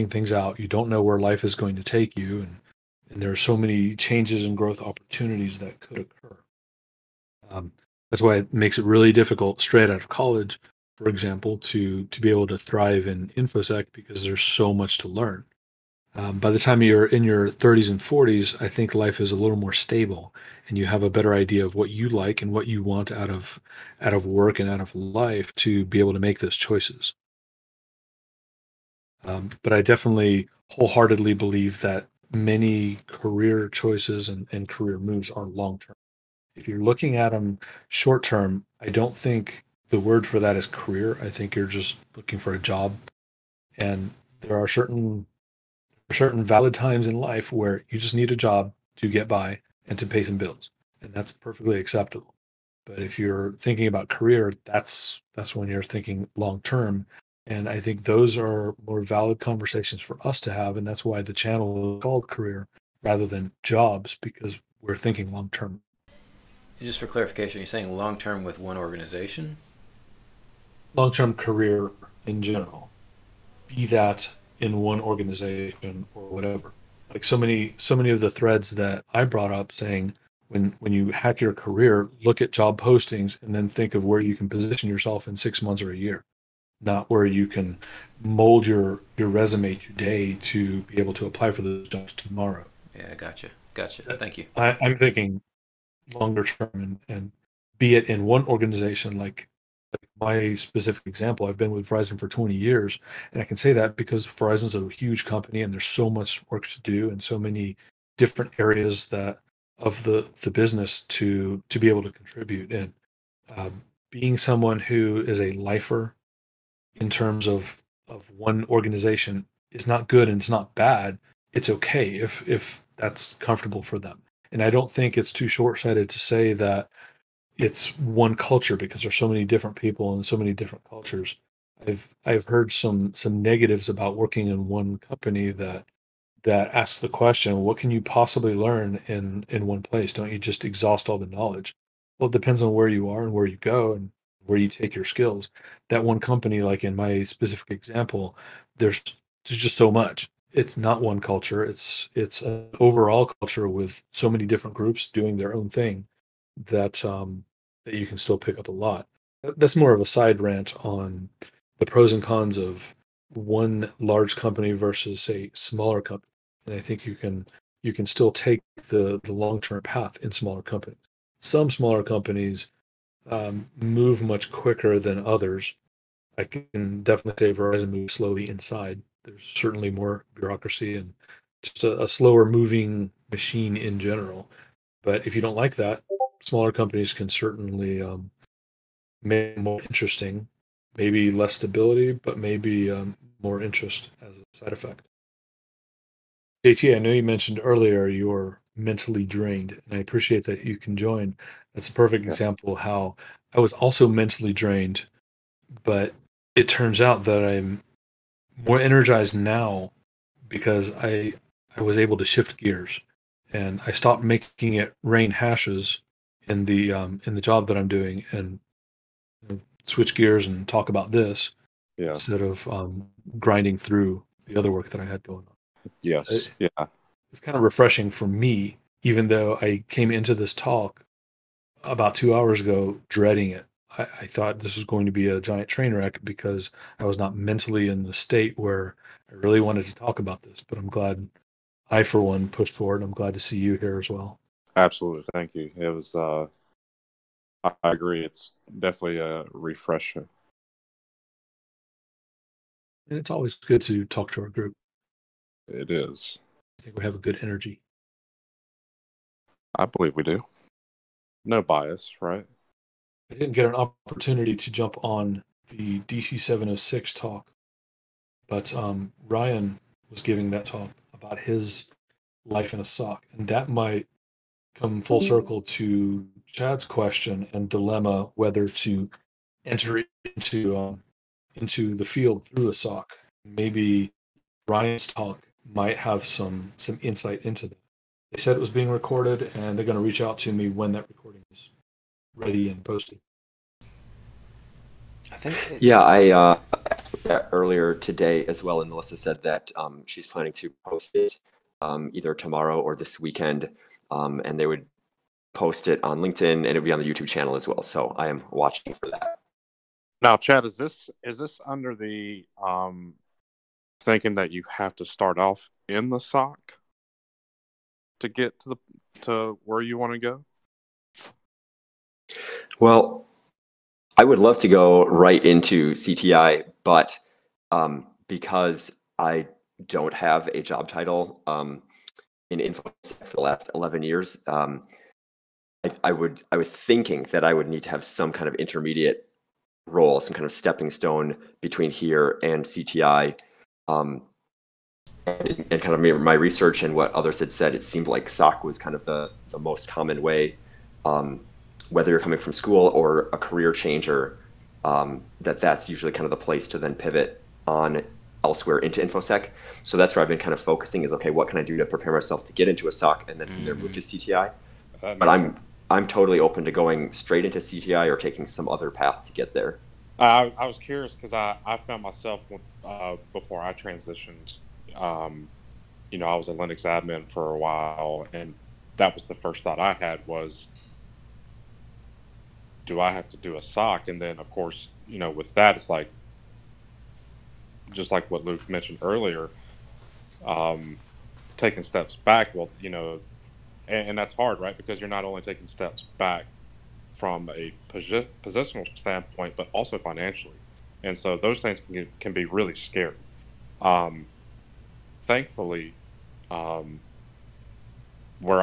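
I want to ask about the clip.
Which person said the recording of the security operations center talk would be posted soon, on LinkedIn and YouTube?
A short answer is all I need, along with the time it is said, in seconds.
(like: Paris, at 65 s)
Melissa, at 298 s.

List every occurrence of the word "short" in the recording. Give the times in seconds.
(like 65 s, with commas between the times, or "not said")
37 s, 125 s.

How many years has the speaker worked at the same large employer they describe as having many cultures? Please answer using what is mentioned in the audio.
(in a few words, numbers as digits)
20.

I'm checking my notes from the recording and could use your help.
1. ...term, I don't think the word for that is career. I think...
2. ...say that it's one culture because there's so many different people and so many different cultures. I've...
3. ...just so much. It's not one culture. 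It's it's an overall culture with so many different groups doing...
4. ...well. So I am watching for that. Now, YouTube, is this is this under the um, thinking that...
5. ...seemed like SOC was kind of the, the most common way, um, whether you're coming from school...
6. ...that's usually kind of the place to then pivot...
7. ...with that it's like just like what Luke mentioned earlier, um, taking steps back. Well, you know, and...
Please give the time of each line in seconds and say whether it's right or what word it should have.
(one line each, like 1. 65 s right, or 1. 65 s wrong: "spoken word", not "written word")
1. 38 s right
2. 126 s right
3. 149 s right
4. 307 s wrong: "Chad", not "YouTube"
5. 347 s right
6. 355 s right
7. 385 s right.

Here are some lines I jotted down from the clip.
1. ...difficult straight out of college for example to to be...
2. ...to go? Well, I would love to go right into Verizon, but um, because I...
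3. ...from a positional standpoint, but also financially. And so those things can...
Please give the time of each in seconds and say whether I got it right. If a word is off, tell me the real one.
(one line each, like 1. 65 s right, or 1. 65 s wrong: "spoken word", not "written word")
1. 9 s right
2. 320 s wrong: "CTI", not "Verizon"
3. 397 s right.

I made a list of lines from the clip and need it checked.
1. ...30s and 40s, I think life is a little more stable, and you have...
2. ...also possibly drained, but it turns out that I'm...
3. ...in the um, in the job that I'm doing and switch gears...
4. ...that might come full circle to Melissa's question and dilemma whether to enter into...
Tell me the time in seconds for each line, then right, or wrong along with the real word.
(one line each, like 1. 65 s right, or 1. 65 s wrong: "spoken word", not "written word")
1. 17 s right
2. 203 s wrong: "mentally", not "possibly"
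3. 216 s right
4. 273 s wrong: "Chad", not "Melissa".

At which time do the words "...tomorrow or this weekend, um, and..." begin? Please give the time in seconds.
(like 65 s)
302 s.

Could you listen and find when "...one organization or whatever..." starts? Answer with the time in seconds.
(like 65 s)
74 s.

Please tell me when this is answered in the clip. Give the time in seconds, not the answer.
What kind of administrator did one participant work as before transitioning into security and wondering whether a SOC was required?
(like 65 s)
376 s.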